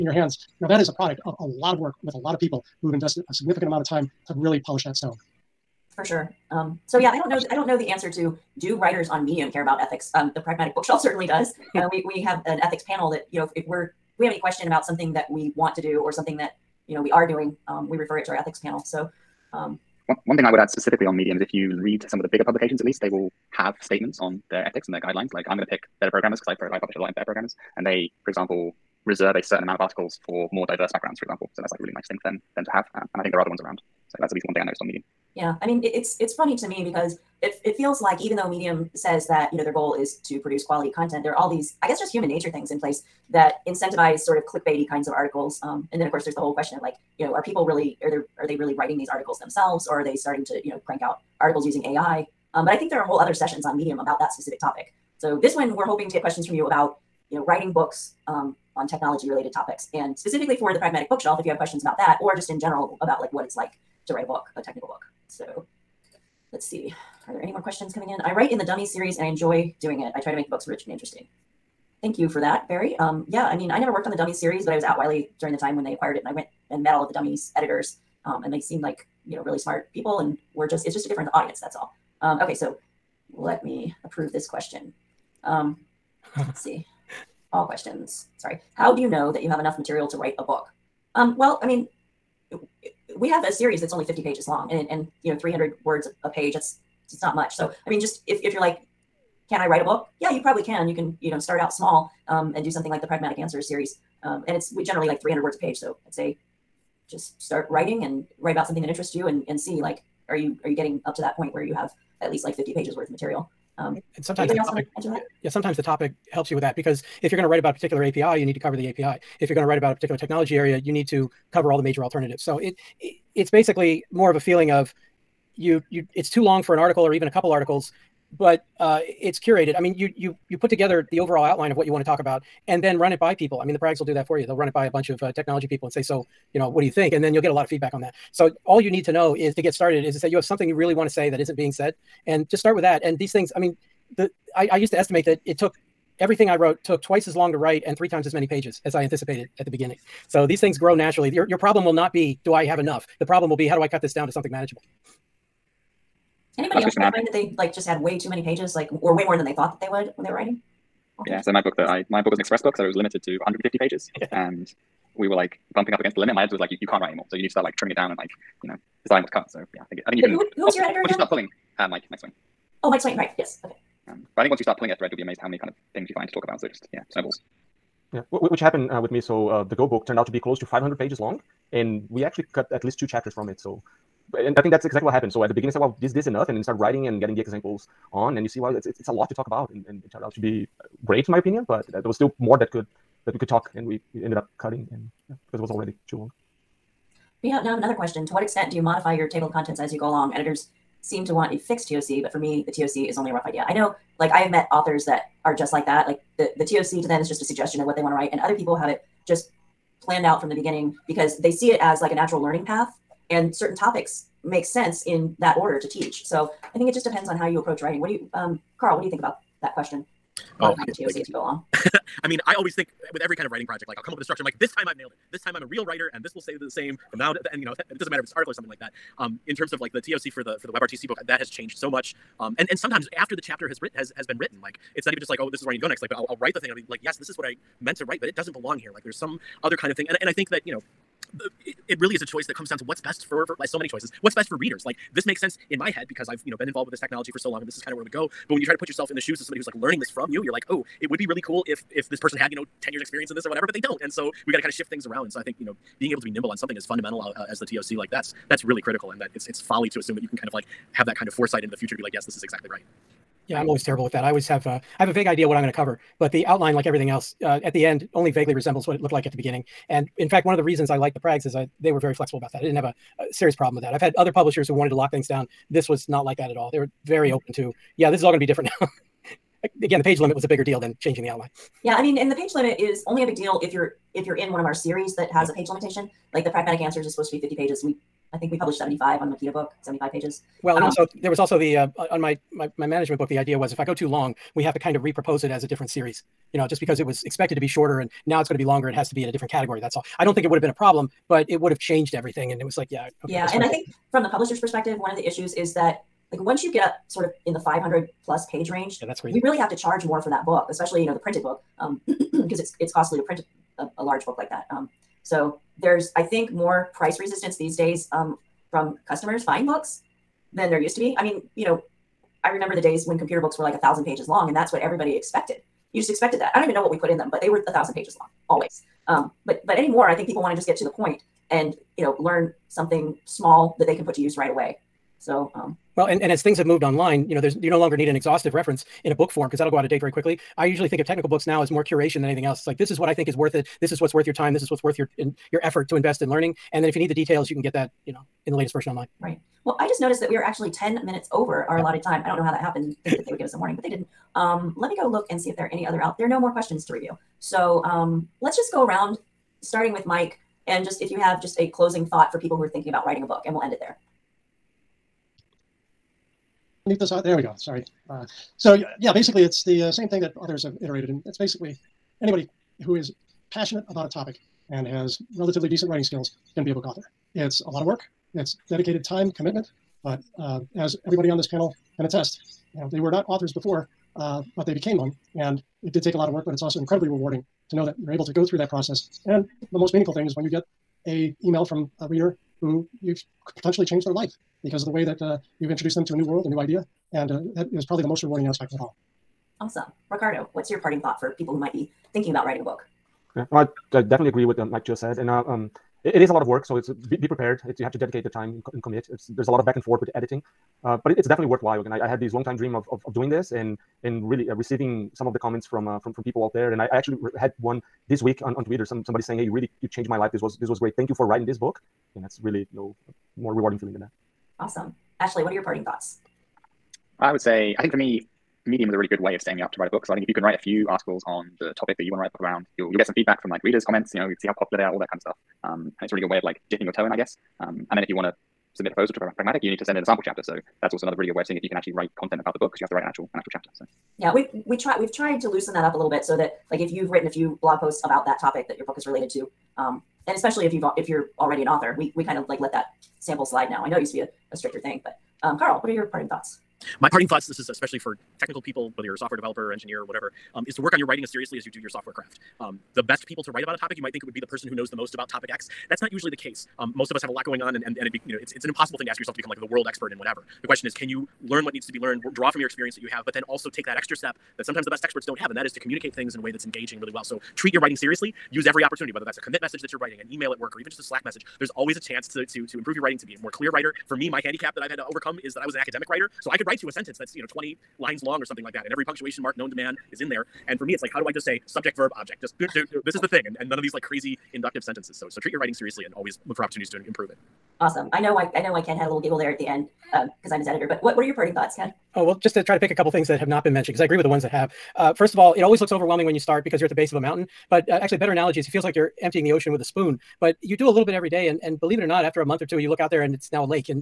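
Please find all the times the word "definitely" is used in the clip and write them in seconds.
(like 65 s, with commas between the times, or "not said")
404 s, 411 s.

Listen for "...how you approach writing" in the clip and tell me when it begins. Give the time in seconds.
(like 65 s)
217 s.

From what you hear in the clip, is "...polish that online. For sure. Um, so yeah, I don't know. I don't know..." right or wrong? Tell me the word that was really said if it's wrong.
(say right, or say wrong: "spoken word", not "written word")
wrong: "stone", not "online".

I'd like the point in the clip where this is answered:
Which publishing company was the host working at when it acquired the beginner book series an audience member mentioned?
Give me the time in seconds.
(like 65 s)
74 s.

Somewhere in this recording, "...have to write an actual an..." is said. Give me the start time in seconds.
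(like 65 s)
442 s.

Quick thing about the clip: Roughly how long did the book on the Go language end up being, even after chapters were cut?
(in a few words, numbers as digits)
500 pages.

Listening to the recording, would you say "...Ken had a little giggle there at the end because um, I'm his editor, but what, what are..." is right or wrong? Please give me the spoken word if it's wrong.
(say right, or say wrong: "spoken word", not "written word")
right.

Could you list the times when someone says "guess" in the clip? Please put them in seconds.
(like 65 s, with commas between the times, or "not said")
41 s, 437 s.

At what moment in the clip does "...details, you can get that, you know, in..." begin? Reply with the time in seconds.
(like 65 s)
347 s.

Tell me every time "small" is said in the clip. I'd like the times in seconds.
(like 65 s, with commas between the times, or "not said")
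101 s, 333 s.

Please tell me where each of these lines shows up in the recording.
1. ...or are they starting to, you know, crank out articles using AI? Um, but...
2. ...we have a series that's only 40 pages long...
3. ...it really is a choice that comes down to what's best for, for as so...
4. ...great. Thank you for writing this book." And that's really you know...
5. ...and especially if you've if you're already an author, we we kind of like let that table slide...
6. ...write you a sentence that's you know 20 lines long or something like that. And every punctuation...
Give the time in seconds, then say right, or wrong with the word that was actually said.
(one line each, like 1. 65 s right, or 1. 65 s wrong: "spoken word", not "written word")
1. 49 s right
2. 93 s wrong: "50", not "40"
3. 241 s right
4. 420 s right
5. 450 s wrong: "sample", not "table"
6. 486 s right.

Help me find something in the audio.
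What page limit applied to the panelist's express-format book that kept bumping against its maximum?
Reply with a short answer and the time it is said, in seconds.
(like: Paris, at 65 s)
150 pages, at 163 s.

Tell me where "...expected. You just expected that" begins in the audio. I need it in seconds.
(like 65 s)
325 s.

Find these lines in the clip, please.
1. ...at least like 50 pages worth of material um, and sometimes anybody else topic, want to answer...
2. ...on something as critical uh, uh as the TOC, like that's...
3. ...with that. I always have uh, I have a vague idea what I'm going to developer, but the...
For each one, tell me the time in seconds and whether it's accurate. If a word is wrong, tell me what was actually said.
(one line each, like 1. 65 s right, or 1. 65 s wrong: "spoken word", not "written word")
1. 112 s right
2. 256 s wrong: "fundamental", not "critical"
3. 264 s wrong: "cover", not "developer".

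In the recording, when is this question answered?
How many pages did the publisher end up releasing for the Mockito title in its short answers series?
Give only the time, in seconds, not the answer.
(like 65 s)
289 s.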